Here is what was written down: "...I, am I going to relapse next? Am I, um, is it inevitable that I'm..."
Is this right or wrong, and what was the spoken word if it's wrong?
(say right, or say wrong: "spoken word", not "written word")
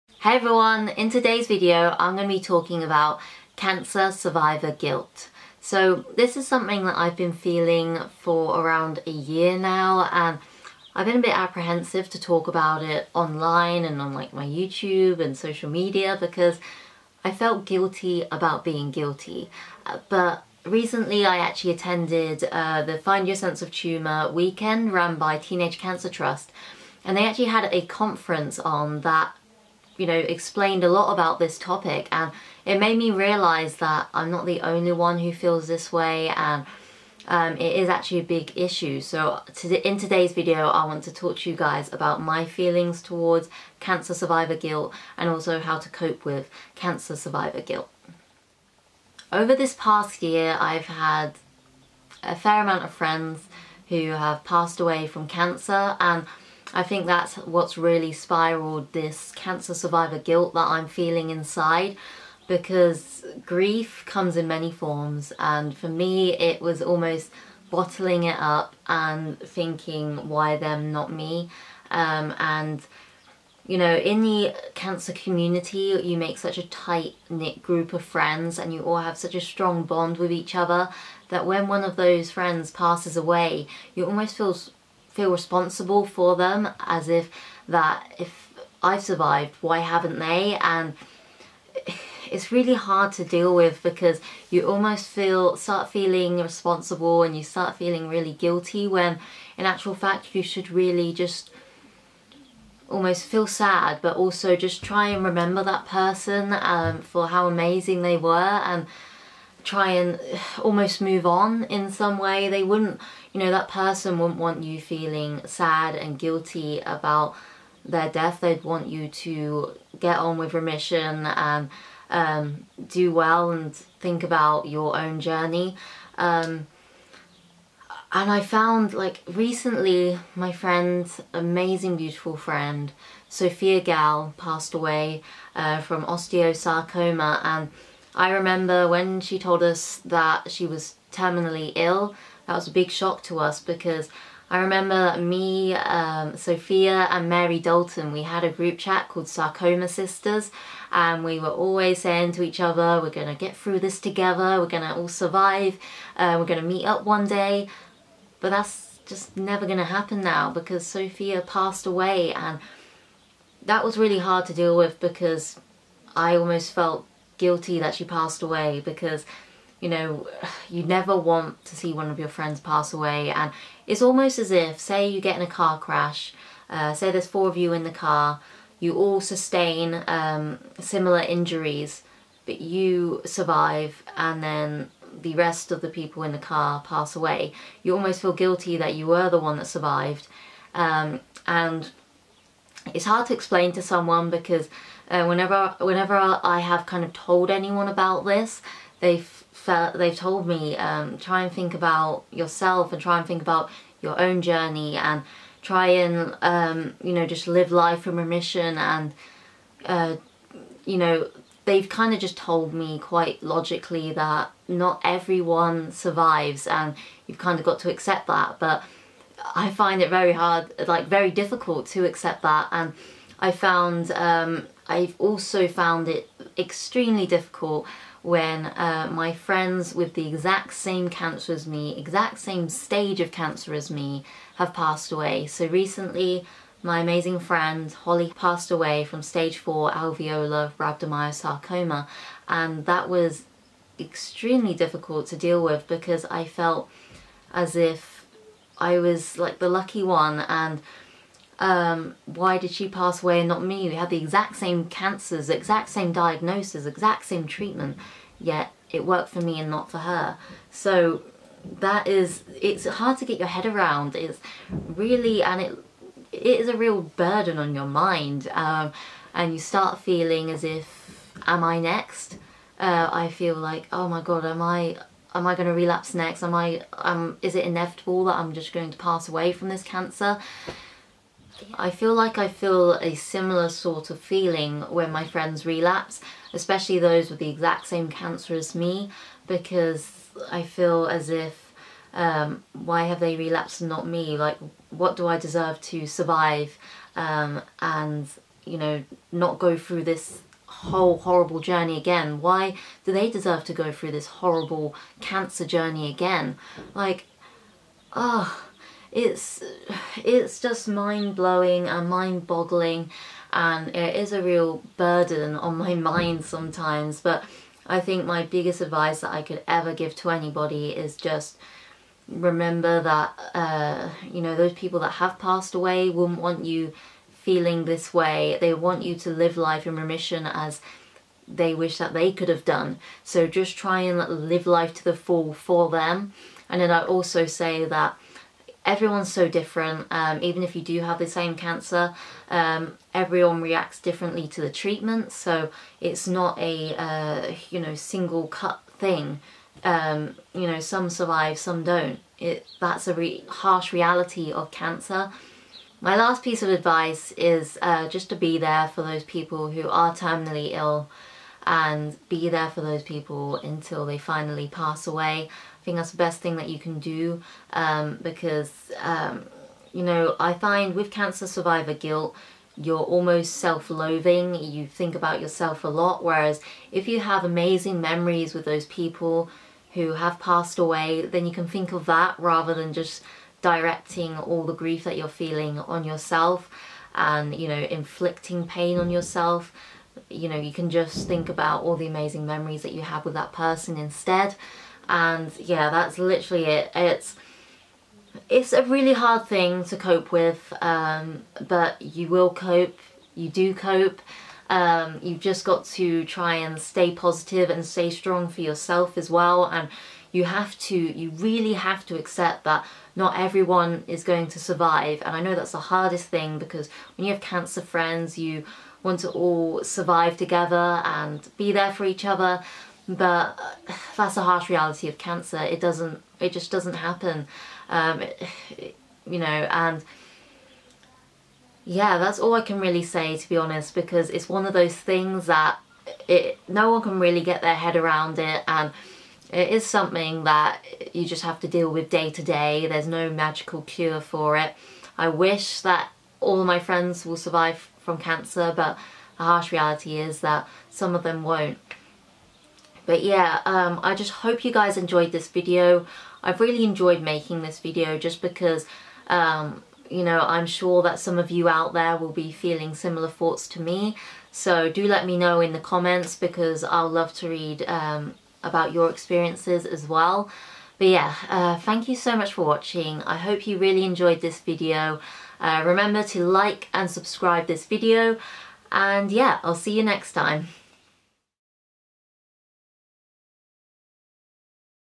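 right.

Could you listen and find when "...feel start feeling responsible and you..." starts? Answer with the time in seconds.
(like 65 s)
95 s.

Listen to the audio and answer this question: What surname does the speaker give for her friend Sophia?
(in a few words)
Gal.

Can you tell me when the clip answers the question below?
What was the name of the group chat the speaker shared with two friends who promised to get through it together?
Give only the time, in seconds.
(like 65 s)
149 s.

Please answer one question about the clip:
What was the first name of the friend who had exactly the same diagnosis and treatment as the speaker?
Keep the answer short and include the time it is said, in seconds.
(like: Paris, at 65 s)
Holly, at 237 s.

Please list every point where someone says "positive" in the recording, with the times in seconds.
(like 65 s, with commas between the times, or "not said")
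407 s.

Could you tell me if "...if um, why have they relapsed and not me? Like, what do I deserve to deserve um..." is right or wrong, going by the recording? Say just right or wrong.
wrong.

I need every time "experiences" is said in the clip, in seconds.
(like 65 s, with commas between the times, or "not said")
469 s.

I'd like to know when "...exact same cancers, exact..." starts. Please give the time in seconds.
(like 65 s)
254 s.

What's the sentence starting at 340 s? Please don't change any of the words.
Um, even if you do have the same cancer, um, everyone reacts differently to the treatment.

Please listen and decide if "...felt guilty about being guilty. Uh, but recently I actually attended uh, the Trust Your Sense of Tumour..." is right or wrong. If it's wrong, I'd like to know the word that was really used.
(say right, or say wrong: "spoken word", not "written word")
wrong: "Find", not "Trust".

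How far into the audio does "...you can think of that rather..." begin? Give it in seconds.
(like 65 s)
381 s.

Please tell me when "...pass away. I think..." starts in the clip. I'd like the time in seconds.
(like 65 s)
364 s.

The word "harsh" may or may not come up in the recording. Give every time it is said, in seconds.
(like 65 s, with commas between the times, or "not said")
353 s, 424 s, 449 s.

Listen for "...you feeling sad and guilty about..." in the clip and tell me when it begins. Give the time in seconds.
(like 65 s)
114 s.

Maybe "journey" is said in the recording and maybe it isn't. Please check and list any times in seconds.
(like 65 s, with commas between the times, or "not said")
125 s, 204 s, 301 s, 305 s.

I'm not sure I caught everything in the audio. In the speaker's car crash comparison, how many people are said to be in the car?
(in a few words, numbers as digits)
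4.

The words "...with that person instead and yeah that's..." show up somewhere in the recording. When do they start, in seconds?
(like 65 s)
393 s.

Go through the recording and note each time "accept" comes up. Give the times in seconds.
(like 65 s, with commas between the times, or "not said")
217 s, 222 s, 412 s.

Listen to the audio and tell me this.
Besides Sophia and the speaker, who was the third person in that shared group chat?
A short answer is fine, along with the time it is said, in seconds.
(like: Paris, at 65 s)
Mary Dalton, at 147 s.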